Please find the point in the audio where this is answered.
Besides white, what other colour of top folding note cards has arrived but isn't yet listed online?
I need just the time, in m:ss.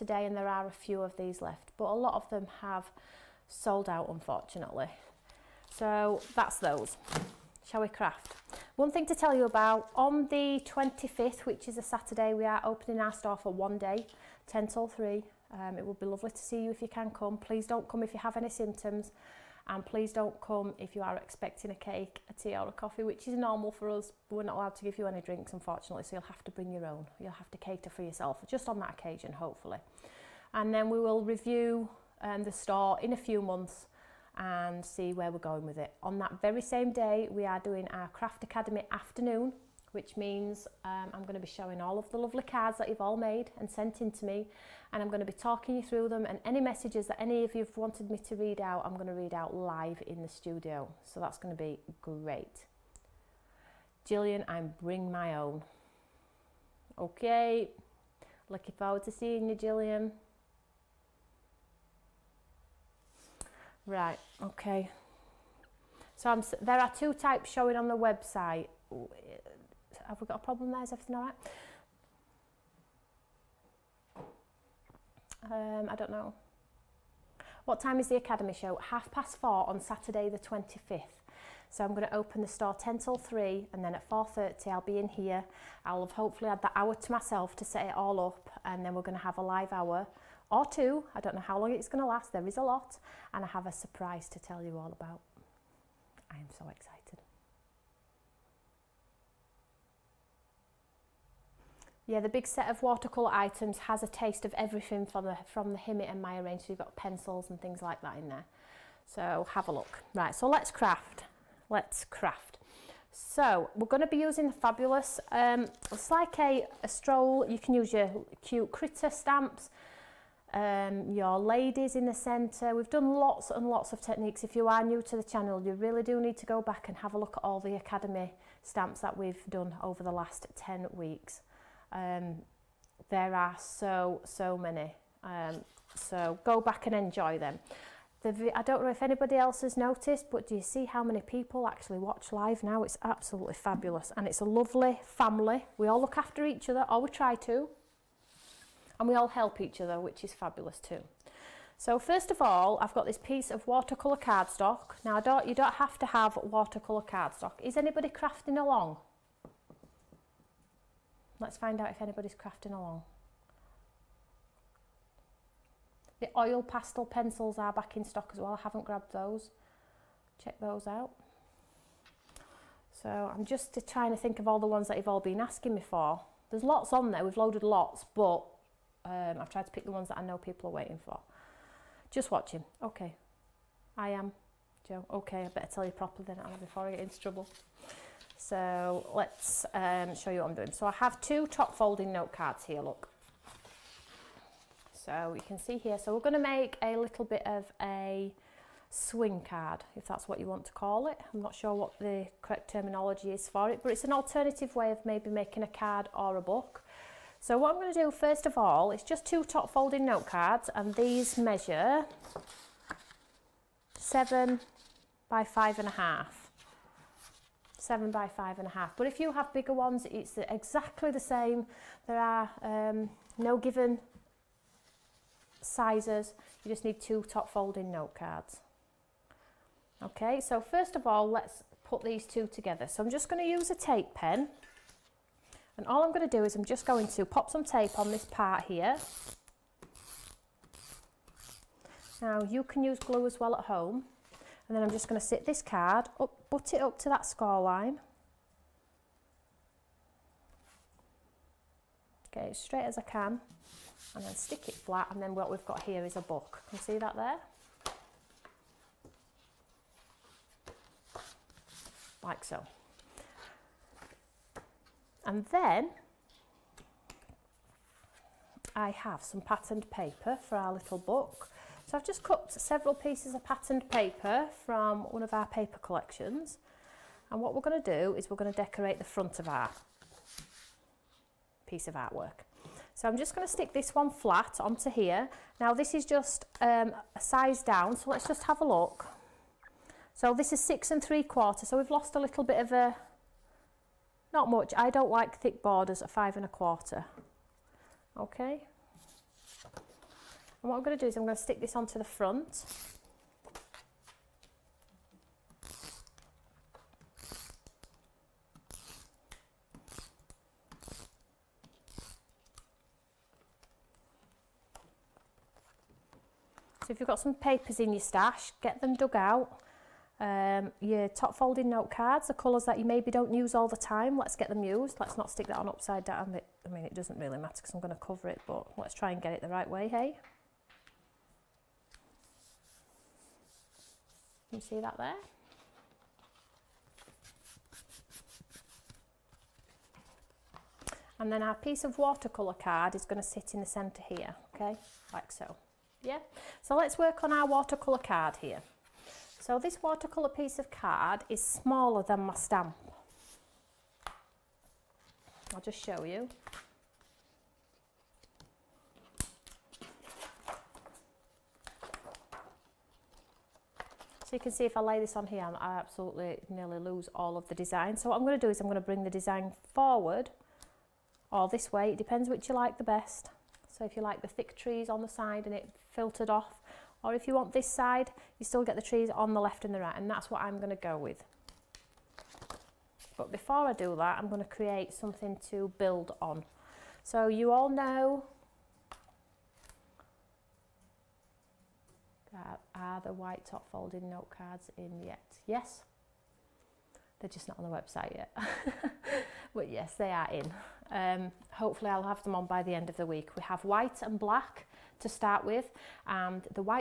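6:44.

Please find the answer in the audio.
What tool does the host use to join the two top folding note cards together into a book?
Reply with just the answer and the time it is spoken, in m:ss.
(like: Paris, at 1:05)
Tape pen, at 3:53.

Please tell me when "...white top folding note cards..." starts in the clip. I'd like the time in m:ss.
6:33.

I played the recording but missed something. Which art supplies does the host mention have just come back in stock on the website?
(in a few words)
Oil pastel pencils.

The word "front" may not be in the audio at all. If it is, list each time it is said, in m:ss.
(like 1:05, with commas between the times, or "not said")
4:39, 5:02.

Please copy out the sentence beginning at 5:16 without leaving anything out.
So if you've got some papers in your stash, get them dug out.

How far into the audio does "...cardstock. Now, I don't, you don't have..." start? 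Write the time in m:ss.
2:34.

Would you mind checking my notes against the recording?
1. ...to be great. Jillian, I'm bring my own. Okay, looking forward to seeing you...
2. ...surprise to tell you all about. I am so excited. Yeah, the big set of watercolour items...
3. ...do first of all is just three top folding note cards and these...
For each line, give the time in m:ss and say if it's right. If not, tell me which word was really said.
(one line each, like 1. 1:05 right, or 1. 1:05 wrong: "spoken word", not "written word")
1. 0:51 right
2. 1:33 right
3. 3:27 wrong: "two", not "three".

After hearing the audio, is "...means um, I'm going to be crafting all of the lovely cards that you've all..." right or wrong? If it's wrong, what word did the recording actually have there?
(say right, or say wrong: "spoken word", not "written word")
wrong: "showing", not "crafting".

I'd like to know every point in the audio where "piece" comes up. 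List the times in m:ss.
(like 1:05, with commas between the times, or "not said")
2:33, 4:32, 4:41, 5:41, 5:50.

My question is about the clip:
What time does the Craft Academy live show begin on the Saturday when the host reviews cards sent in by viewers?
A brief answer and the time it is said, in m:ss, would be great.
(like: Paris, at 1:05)
4:30, at 1:18.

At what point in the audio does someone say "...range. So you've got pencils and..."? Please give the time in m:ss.
1:46.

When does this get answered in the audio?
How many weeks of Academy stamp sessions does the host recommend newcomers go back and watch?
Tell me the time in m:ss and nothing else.
2:10.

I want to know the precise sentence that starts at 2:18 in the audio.
The, I don't know if anybody else has noticed, but do you see how many people actually watch live now?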